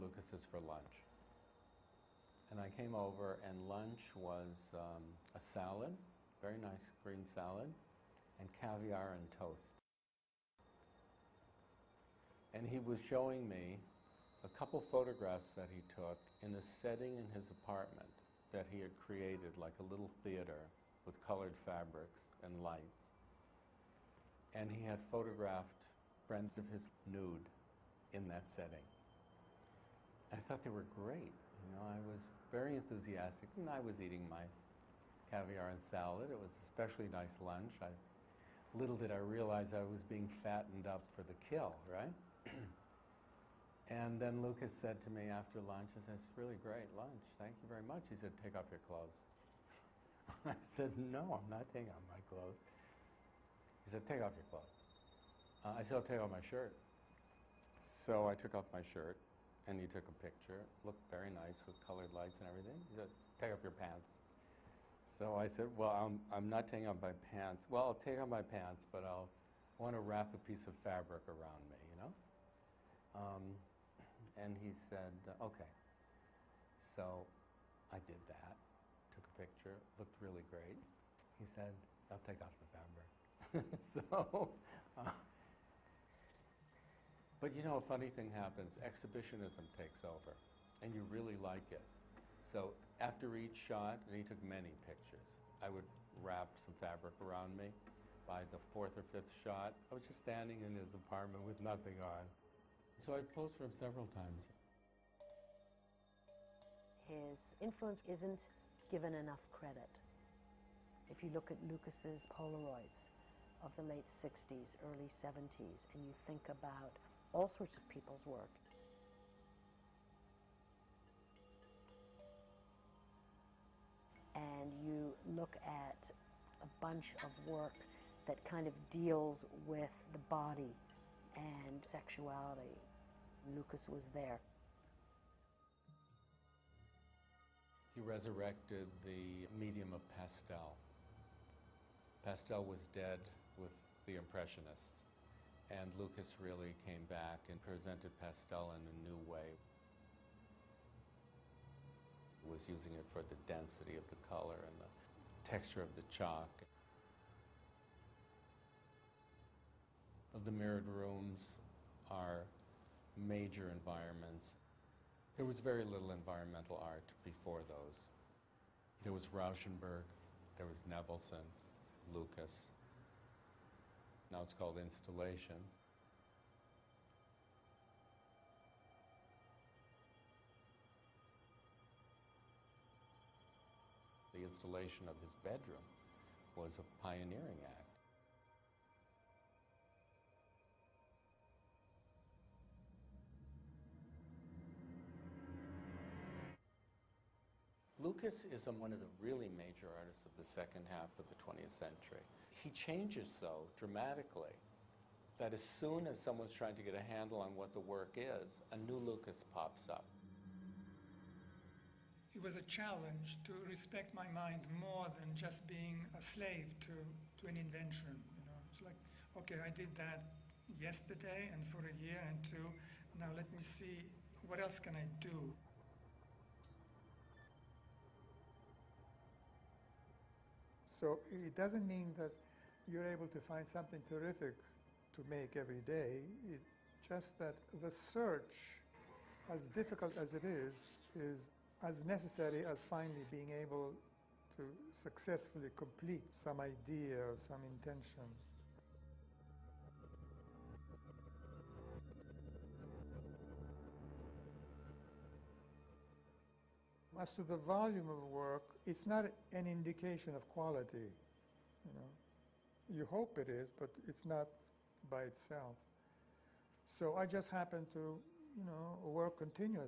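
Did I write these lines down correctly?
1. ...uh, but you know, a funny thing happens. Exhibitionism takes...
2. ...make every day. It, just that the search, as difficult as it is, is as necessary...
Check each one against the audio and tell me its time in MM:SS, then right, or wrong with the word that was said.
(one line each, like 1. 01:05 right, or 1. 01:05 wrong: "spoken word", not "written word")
1. 01:24 right
2. 03:55 right.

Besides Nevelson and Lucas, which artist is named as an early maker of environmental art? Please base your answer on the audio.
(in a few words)
Rauschenberg.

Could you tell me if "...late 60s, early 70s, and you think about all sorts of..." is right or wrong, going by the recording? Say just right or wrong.
right.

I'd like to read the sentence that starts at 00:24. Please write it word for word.
And he had photographed friends of his nude in that setting.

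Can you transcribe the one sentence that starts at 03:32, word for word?
It was a challenge to respect my mind more than just being a slave to, to an invention.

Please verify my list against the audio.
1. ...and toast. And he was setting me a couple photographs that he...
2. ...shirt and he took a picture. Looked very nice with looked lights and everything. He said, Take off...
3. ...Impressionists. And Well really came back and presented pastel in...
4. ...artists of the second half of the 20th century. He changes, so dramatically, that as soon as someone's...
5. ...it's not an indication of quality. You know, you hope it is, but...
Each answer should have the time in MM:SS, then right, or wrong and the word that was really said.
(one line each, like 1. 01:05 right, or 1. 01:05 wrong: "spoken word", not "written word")
1. 00:09 wrong: "showing", not "setting"
2. 00:58 wrong: "colored", not "looked"
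3. 02:24 wrong: "Lucas", not "Well"
4. 03:20 right
5. 04:18 right.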